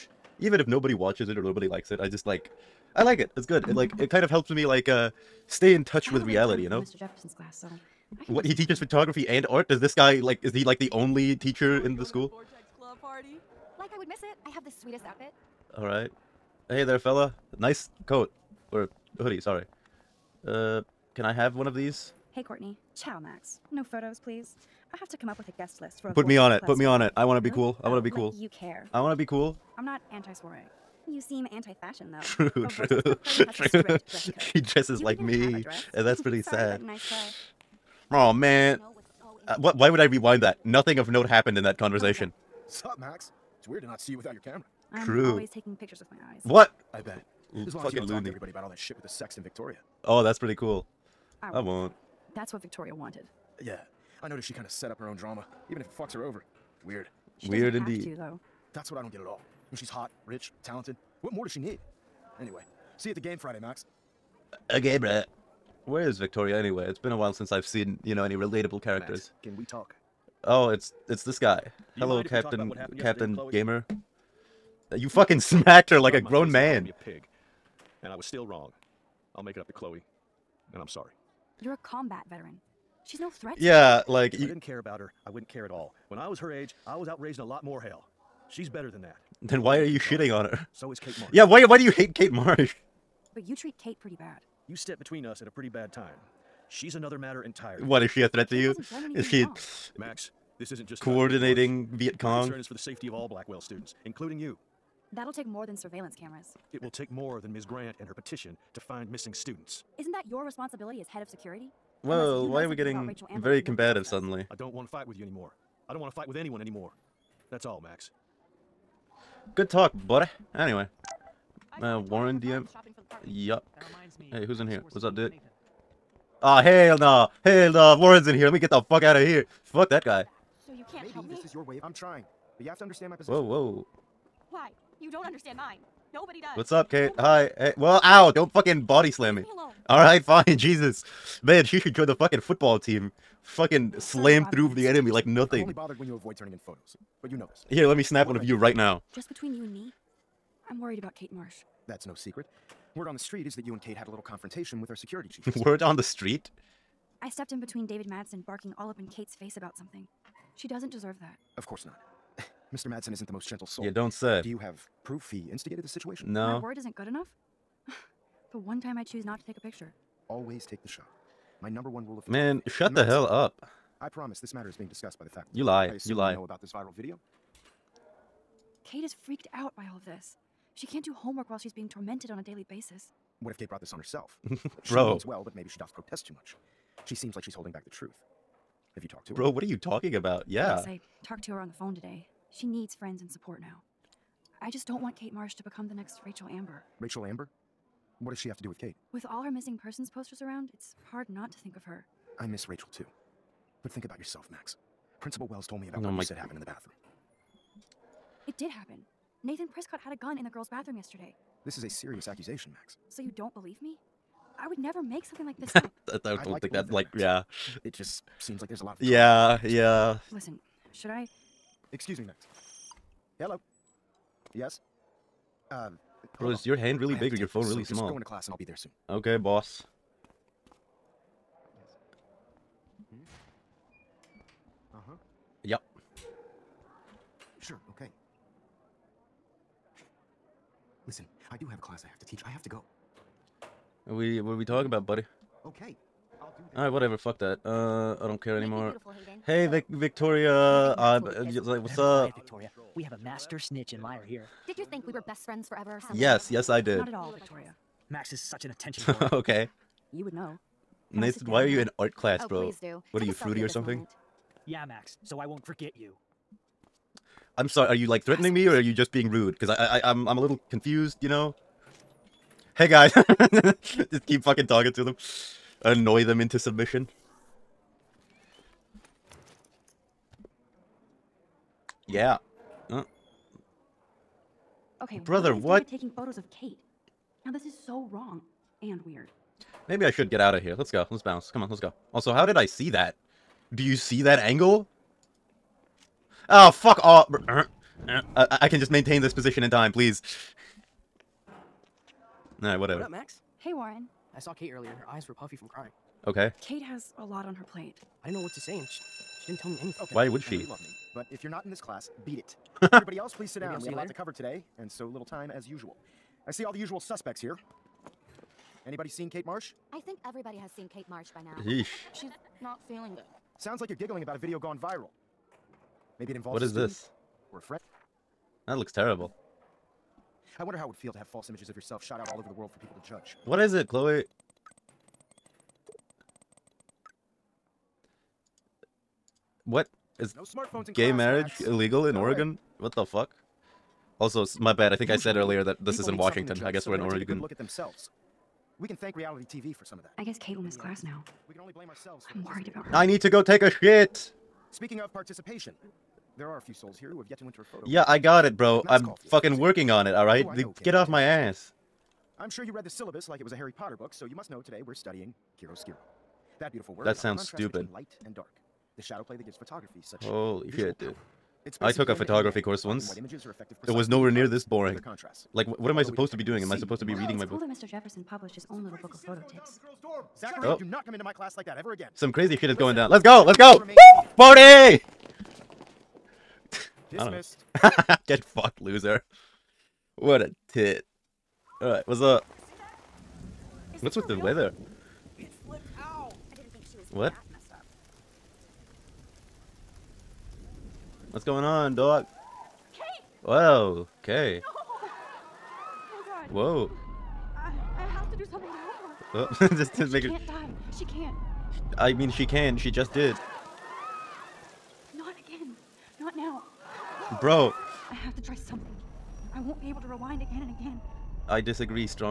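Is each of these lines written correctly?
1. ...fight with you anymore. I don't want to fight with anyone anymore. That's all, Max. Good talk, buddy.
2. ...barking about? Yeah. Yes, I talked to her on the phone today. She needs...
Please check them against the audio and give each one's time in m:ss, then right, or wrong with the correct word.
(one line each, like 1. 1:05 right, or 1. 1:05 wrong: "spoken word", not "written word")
1. 1:54 right
2. 3:09 wrong: "talking", not "barking".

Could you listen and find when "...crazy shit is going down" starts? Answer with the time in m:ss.
6:22.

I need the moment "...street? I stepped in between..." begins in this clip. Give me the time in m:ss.
2:36.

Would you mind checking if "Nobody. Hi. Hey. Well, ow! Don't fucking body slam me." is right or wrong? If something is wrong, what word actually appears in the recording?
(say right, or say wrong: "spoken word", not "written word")
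right.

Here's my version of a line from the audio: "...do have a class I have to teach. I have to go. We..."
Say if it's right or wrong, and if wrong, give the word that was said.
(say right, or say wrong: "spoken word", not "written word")
right.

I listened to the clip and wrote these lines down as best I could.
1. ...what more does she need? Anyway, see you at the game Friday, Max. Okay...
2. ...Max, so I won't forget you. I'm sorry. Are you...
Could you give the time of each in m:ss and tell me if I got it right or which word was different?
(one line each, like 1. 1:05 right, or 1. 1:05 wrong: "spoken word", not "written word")
1. 1:01 right
2. 4:24 right.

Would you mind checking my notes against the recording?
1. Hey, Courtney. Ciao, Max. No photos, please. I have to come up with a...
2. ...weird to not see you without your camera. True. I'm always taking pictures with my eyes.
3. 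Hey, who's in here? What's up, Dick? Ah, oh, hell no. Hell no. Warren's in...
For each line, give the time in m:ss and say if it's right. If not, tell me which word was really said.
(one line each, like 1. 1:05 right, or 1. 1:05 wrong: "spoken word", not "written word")
1. 0:22 right
2. 0:43 right
3. 2:04 right.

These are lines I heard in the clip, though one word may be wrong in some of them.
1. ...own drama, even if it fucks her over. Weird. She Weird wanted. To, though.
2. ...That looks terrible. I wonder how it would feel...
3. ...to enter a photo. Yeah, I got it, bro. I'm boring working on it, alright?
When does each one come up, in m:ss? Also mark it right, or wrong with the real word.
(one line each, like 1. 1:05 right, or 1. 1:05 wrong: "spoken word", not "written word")
1. 0:55 wrong: "indeed", not "wanted"
2. 5:28 right
3. 5:57 wrong: "fucking", not "boring".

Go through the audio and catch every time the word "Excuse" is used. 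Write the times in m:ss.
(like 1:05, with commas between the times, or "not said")
3:41.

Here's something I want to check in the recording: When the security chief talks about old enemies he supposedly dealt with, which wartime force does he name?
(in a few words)
Viet Cong.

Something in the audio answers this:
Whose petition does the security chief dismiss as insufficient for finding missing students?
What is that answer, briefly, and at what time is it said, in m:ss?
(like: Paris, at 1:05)
Ms. Grant, at 1:47.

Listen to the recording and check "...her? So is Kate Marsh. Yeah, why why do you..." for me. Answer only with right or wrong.
right.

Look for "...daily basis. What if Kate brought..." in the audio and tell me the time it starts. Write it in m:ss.
3:02.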